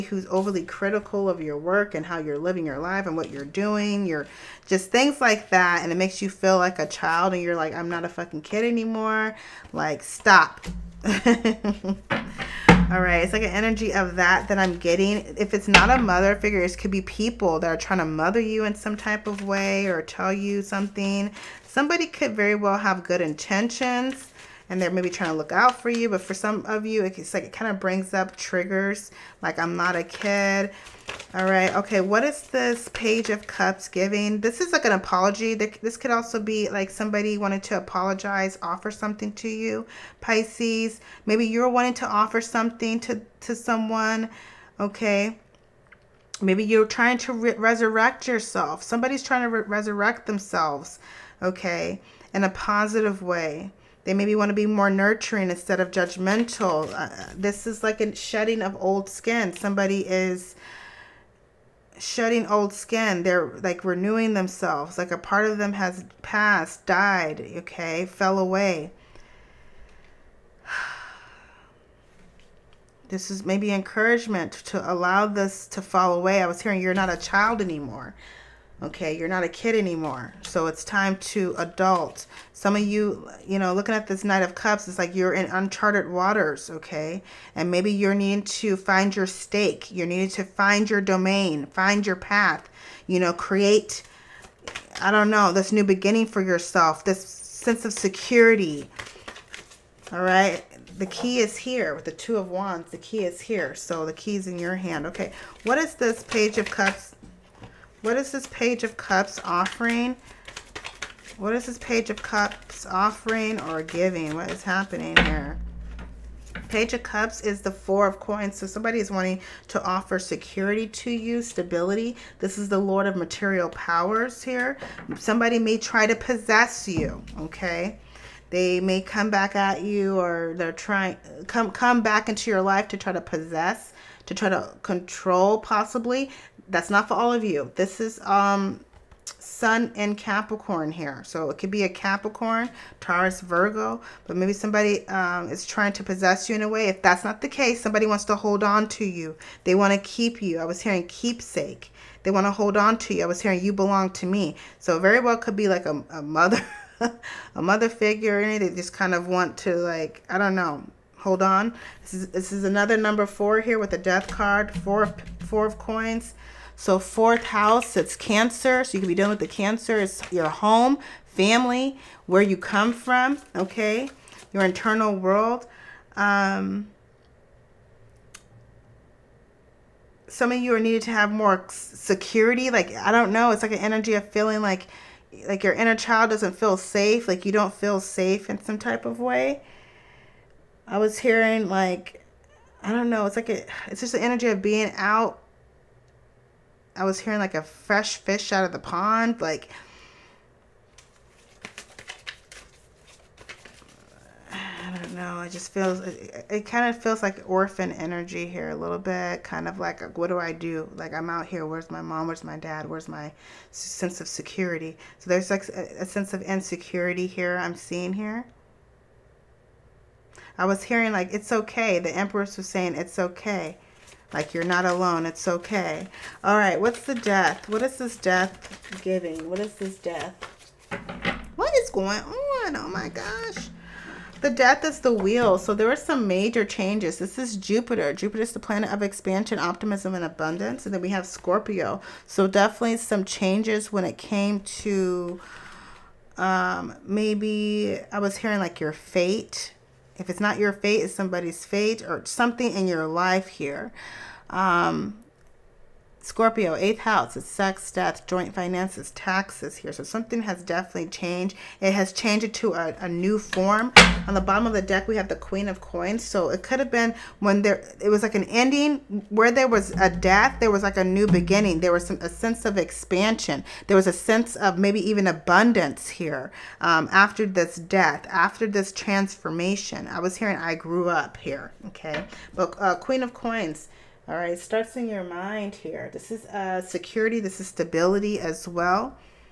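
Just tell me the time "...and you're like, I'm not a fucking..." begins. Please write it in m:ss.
0:07.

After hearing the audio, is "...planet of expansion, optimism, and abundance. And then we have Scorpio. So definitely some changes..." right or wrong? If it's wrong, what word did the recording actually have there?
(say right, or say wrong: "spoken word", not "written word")
right.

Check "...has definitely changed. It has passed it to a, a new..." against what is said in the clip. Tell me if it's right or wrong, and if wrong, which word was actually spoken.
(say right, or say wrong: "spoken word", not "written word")
wrong: "changed", not "passed".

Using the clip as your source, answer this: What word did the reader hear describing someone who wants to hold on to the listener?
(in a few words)
keepsake.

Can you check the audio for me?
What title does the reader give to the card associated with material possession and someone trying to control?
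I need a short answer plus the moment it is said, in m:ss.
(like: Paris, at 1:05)
Lord of Material Powers, at 2:02.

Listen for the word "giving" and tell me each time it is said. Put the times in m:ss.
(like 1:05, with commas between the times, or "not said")
0:33, 1:53, 3:49.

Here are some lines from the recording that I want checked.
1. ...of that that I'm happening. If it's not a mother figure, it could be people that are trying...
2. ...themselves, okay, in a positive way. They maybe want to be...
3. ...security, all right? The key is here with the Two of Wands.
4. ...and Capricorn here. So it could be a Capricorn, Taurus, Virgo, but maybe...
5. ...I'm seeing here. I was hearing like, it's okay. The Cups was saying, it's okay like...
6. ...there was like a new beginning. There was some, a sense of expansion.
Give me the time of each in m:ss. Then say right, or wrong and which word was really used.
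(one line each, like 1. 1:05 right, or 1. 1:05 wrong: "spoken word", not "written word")
1. 0:13 wrong: "getting", not "happening"
2. 0:50 right
3. 1:37 right
4. 2:19 right
5. 3:37 wrong: "Empress", not "Cups"
6. 4:30 right.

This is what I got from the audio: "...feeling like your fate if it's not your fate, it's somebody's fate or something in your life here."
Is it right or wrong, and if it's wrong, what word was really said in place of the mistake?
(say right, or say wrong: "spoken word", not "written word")
wrong: "hearing", not "feeling".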